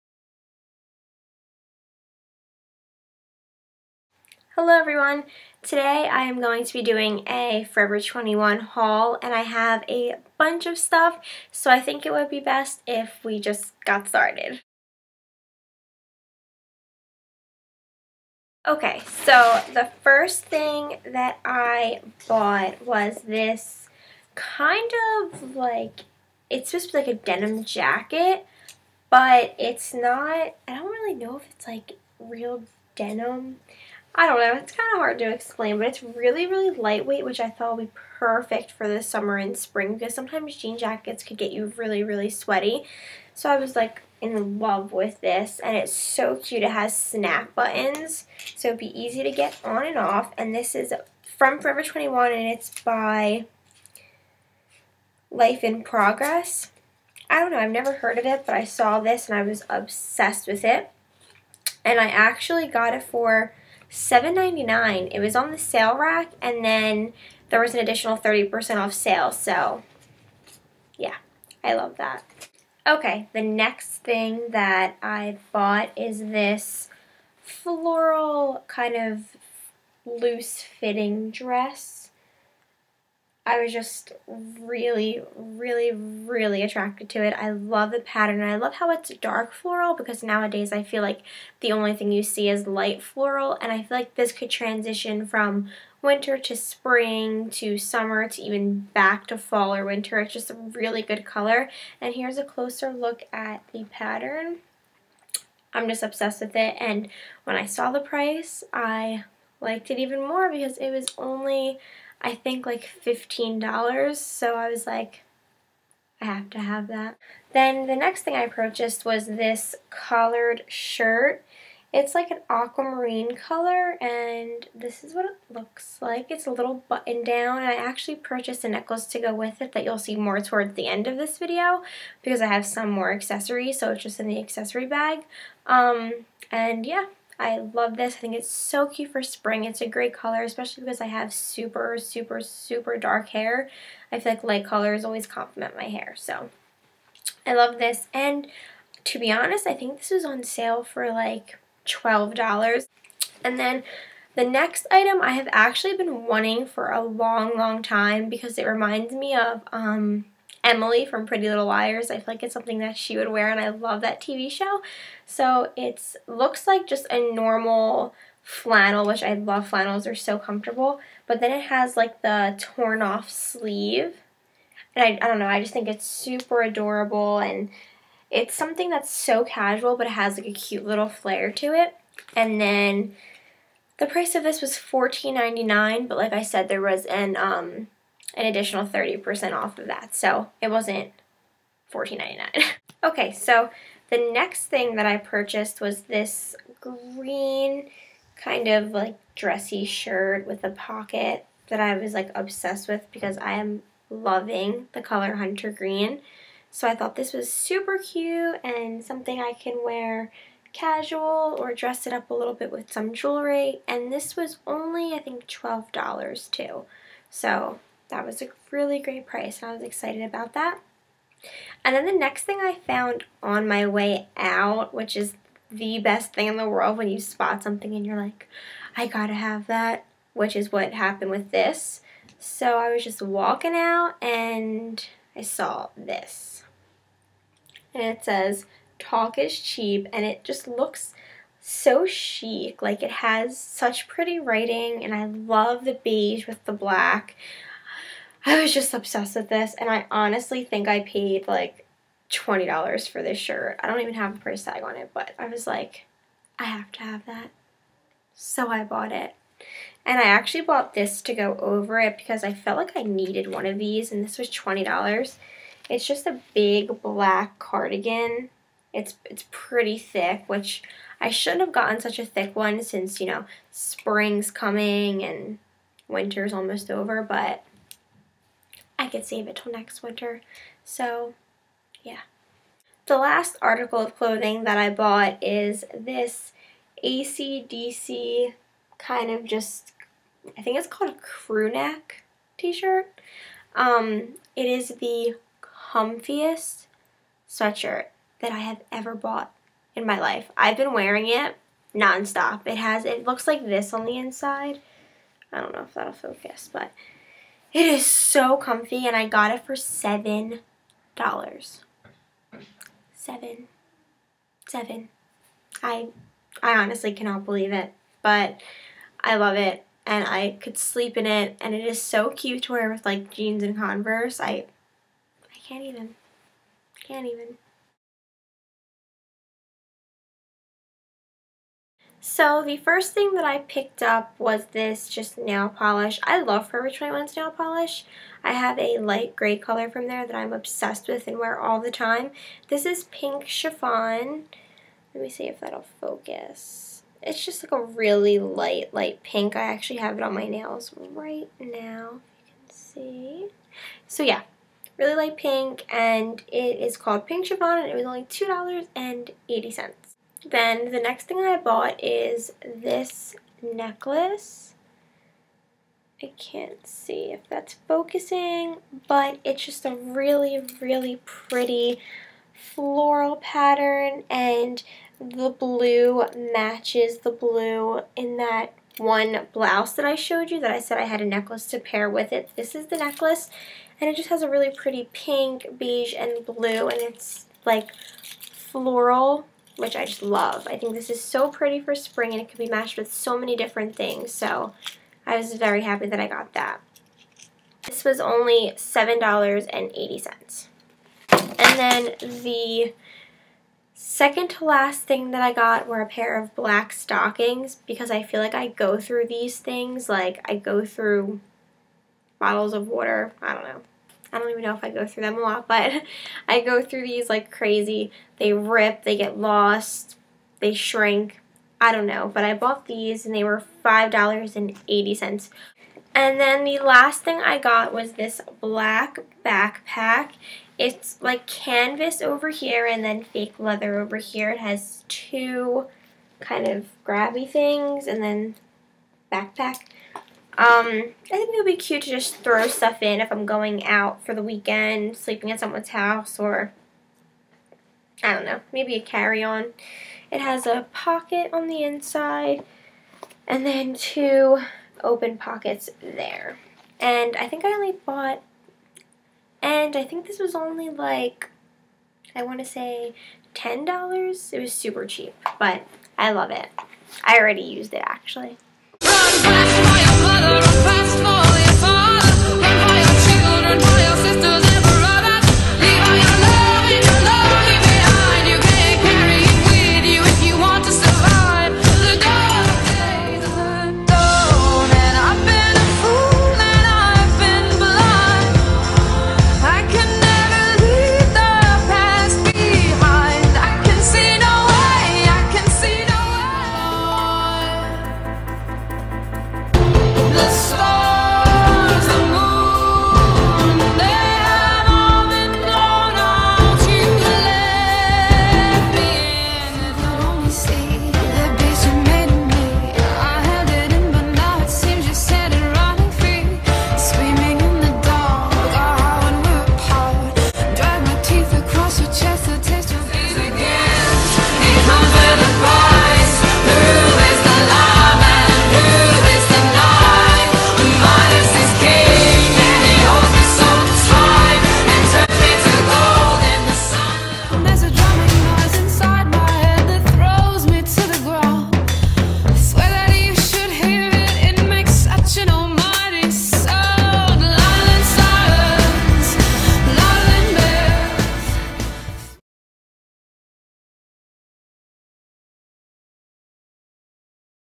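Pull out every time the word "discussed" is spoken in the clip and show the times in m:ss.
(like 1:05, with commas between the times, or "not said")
not said.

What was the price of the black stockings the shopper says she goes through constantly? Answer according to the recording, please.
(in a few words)
$5.80.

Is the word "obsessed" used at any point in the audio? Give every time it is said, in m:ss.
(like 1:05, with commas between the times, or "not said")
0:59, 1:46, 3:22, 4:08, 5:40.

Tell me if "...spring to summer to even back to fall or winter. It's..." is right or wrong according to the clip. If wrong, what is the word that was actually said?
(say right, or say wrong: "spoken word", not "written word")
right.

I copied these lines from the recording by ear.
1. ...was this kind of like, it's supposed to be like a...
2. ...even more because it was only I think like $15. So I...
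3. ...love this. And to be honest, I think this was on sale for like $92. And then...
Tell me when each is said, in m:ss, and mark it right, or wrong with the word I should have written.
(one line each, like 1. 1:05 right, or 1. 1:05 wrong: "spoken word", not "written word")
1. 0:22 right
2. 1:49 right
3. 2:27 wrong: "12", not "92".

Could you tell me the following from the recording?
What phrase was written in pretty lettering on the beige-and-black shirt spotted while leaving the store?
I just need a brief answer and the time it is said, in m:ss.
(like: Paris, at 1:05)
Talk is cheap, at 3:58.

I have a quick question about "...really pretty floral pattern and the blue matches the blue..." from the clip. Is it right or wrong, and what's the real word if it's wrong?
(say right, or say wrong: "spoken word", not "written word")
right.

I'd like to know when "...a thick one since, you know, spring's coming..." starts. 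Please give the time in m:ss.
4:32.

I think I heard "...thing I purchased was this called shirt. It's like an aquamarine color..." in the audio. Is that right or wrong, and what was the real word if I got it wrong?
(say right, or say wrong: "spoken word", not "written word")
wrong: "collared", not "called".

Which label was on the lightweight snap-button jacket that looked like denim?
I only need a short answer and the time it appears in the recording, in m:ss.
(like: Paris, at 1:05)
Life in Progress, at 0:55.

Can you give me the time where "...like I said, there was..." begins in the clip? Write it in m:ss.
3:06.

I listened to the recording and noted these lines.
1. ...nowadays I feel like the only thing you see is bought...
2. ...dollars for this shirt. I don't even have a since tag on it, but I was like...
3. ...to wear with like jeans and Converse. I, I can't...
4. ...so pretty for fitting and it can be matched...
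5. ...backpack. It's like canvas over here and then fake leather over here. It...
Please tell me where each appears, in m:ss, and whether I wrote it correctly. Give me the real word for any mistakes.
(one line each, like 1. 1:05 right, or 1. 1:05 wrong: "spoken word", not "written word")
1. 1:30 wrong: "light", not "bought"
2. 4:12 wrong: "price", not "since"
3. 5:22 right
4. 6:31 wrong: "spring", not "fitting"
5. 7:09 right.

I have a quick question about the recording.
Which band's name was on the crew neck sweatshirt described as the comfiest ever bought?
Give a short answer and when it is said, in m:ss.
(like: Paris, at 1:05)
ACDC, at 4:47.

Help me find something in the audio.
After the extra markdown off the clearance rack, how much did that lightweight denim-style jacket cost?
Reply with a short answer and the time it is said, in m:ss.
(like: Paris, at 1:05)
$7.99, at 1:03.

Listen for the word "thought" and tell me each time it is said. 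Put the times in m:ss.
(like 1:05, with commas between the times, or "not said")
0:37, 3:26.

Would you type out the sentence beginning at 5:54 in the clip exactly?
So yeah, really light pink and it is called Pink Chiffon and it was only $2.80.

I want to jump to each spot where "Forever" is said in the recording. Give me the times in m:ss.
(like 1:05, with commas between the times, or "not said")
0:07, 0:51, 5:36.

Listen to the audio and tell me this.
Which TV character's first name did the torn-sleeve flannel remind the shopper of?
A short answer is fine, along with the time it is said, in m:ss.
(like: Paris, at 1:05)
Emily, at 2:40.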